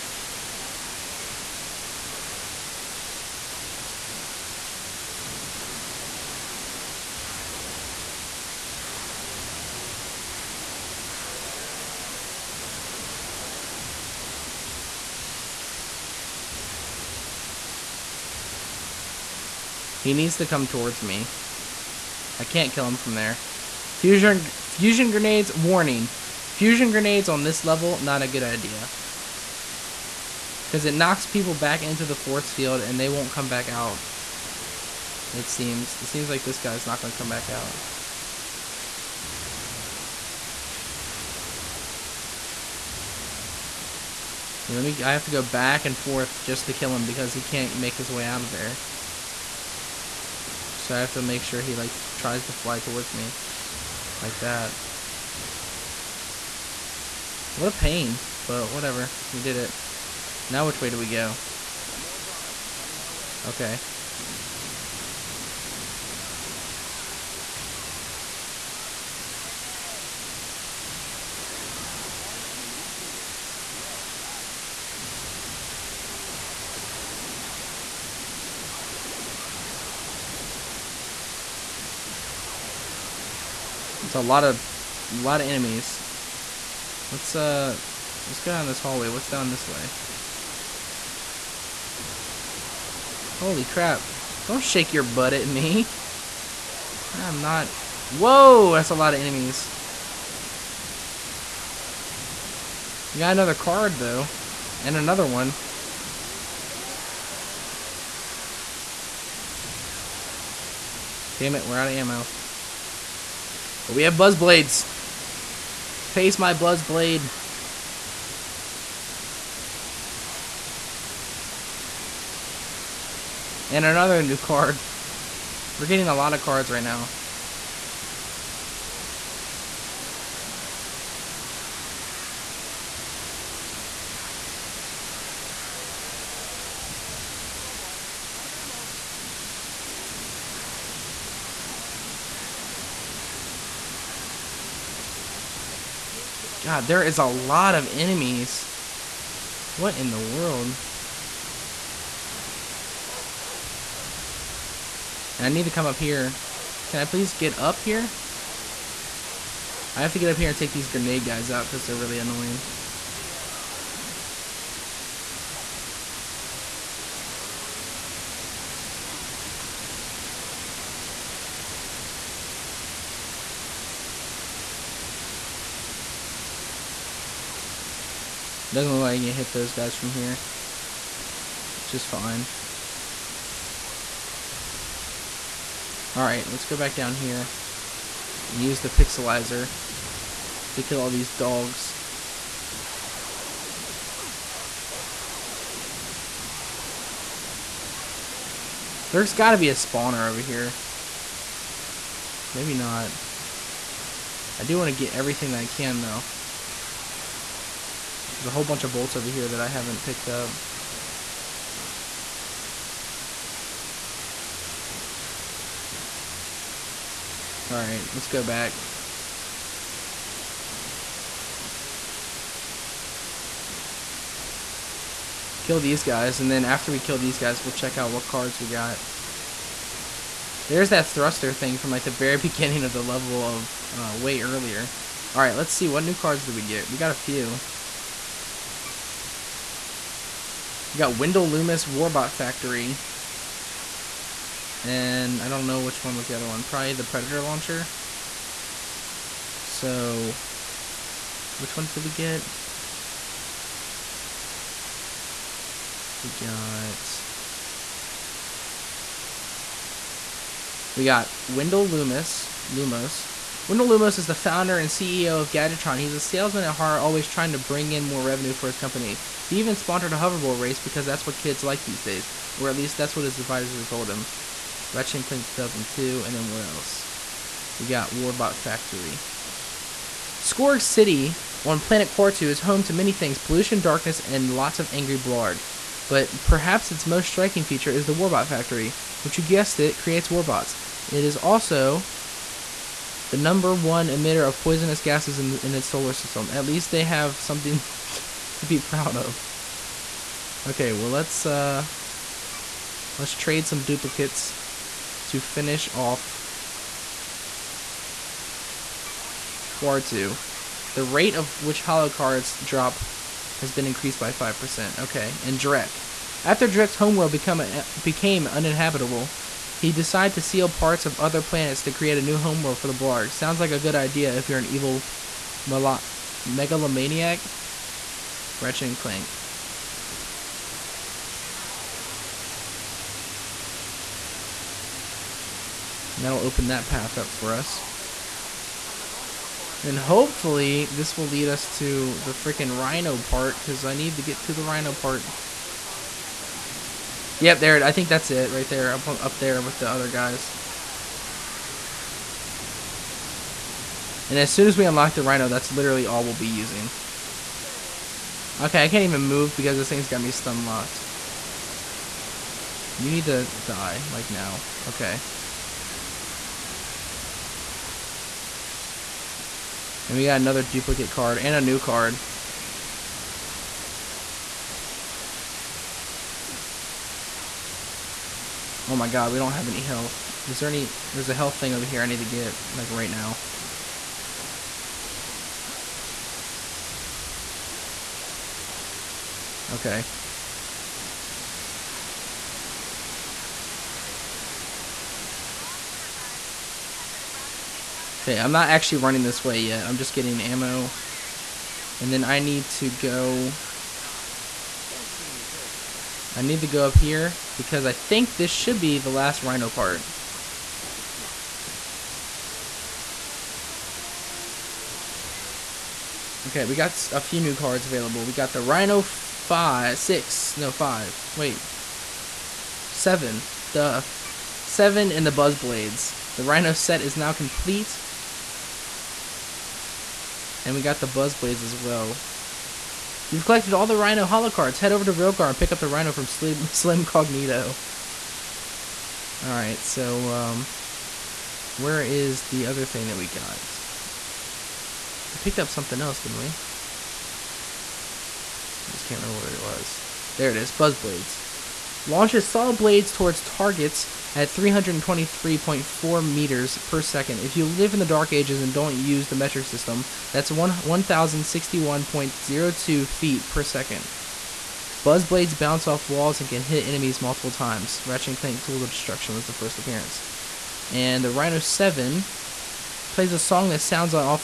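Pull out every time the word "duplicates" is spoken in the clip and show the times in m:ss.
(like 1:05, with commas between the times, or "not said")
5:03, 6:10.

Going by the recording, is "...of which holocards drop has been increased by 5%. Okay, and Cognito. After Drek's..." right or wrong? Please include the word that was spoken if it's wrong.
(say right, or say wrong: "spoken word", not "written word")
wrong: "Drek", not "Cognito".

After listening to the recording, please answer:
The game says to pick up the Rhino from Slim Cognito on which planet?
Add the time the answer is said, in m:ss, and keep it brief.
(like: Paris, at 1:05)
Rilgar, at 7:15.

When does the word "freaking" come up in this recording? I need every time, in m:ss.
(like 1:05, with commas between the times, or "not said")
5:42.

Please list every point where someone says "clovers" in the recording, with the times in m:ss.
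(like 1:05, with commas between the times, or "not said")
not said.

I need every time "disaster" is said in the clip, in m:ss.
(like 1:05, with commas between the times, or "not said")
not said.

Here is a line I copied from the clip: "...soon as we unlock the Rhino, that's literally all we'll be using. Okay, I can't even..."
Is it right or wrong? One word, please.
right.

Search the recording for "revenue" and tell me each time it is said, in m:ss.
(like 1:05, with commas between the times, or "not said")
4:28.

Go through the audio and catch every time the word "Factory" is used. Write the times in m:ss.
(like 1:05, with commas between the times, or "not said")
4:02, 4:38, 4:48.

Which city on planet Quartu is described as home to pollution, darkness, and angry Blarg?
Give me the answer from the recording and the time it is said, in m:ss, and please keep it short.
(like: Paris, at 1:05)
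Skorg City, at 4:40.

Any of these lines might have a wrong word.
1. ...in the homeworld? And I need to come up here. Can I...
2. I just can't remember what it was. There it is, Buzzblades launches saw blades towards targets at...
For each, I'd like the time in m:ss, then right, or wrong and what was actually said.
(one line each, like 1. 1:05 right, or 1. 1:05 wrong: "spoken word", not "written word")
1. 2:29 wrong: "world", not "homeworld"
2. 7:28 right.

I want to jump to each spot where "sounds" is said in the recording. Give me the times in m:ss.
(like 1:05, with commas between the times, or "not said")
5:23, 7:53.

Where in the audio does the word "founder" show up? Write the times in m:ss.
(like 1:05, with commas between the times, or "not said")
4:24.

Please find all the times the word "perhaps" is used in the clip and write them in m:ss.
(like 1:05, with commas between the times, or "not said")
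4:46.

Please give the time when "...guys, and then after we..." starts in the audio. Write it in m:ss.
3:46.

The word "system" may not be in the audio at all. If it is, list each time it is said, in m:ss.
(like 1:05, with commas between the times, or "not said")
4:56, 7:39.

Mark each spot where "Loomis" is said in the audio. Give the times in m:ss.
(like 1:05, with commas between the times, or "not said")
4:01, 4:21.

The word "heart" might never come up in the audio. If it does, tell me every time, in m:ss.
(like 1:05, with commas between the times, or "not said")
4:26.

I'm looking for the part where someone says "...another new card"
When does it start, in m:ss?
2:03.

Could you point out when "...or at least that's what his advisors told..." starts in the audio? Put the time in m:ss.
4:32.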